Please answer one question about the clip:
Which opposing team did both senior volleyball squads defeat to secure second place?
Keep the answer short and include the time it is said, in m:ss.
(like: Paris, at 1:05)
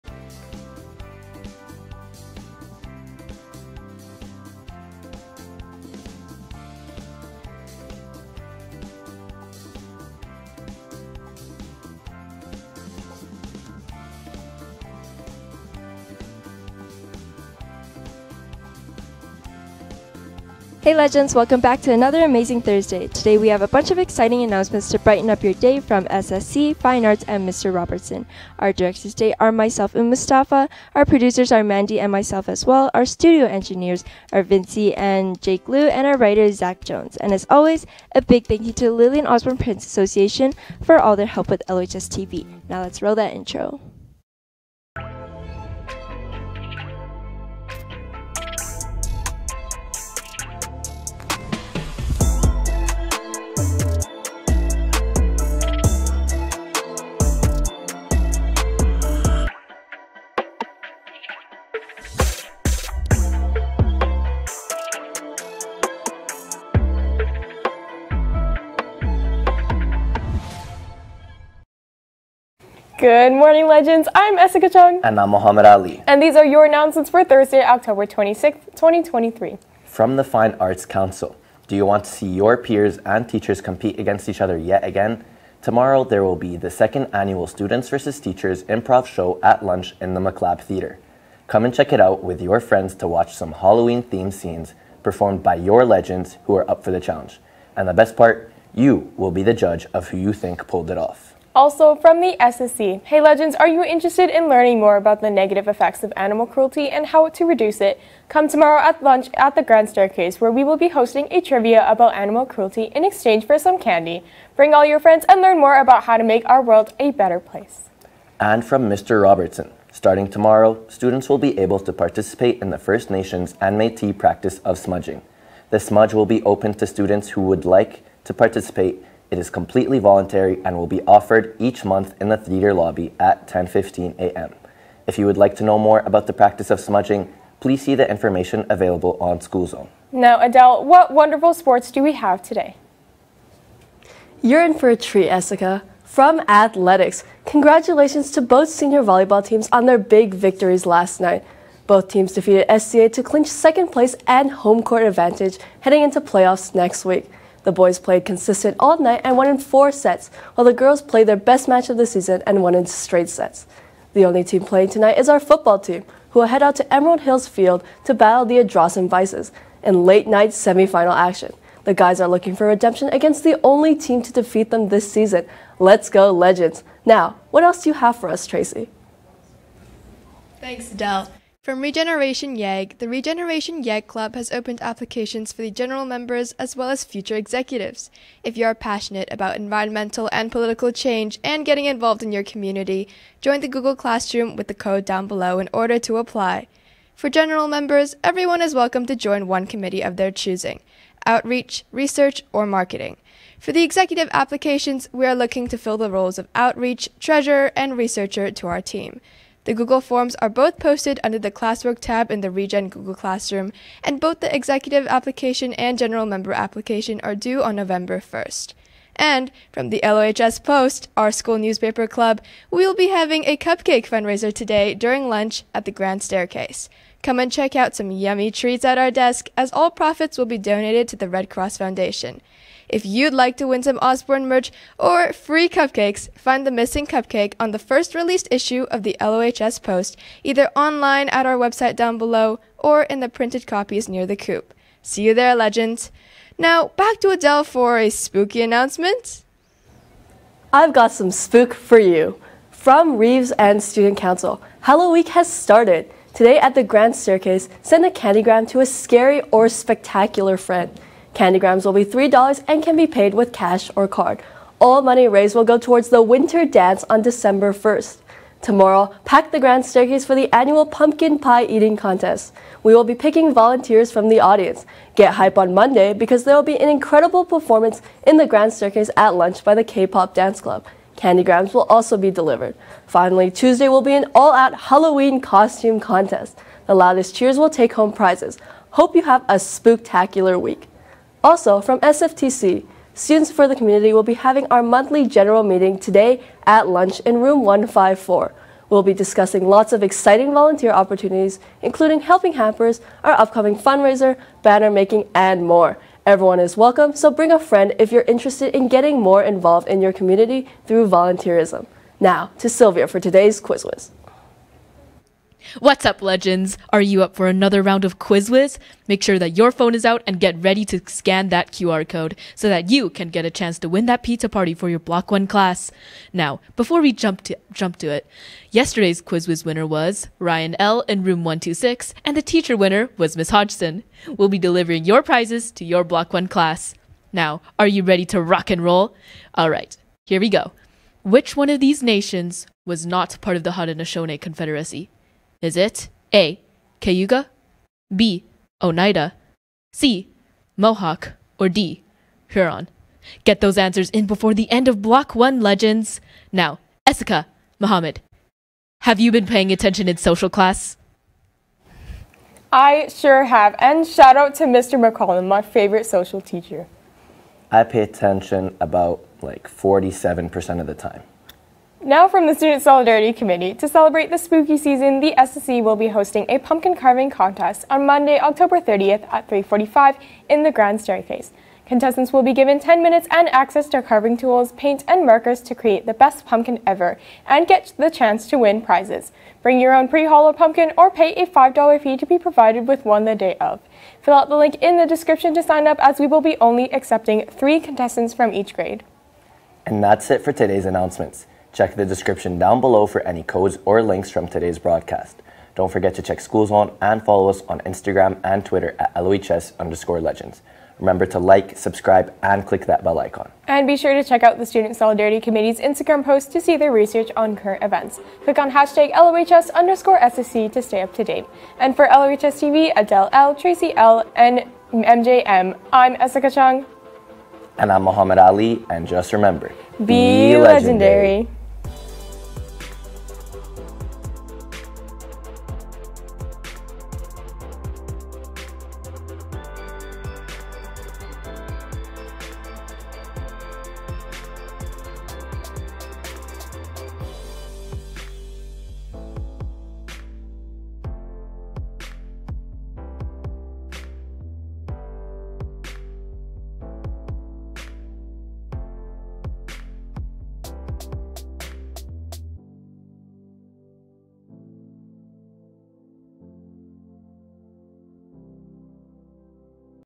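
SCA, at 2:32.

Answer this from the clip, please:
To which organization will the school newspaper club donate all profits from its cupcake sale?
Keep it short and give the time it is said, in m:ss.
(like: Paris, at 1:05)
Red Cross Foundation, at 3:51.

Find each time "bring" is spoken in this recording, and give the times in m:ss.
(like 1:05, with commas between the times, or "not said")
1:54, 5:07, 6:29.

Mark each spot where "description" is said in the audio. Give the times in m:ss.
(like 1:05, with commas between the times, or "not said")
6:35, 6:42.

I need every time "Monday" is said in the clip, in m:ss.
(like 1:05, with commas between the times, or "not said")
4:35, 6:18.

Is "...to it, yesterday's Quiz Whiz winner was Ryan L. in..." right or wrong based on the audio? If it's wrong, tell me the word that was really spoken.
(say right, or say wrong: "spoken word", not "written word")
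right.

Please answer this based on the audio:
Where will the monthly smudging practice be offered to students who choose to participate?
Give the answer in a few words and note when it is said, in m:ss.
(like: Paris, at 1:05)
theater lobby, at 2:12.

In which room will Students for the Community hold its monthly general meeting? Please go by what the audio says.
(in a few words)
154.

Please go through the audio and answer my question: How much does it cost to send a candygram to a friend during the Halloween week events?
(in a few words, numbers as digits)
$3.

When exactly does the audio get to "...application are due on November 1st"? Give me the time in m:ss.
3:36.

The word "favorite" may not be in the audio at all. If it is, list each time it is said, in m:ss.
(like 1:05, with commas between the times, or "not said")
6:05.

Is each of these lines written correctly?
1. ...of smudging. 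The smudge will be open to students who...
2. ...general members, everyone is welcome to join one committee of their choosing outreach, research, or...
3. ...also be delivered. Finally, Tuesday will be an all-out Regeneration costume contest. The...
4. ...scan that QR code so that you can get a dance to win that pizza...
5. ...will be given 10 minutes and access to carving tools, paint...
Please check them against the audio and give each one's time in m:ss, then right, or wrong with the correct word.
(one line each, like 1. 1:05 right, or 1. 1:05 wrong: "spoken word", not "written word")
1. 2:04 right
2. 3:17 right
3. 4:41 wrong: "Halloween", not "Regeneration"
4. 5:21 wrong: "chance", not "dance"
5. 6:22 right.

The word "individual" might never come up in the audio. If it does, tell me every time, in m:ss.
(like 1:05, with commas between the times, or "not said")
not said.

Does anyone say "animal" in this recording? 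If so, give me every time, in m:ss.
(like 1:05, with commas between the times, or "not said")
1:46, 1:52.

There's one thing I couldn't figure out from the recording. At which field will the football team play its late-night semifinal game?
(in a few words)
Emerald Hills Field.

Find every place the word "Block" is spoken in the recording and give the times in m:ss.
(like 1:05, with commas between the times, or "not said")
5:24, 5:36, 5:55.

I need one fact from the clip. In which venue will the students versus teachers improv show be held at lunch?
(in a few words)
Maclab Theater.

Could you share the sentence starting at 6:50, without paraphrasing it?
Remember to like, subscribe, and click that bell icon.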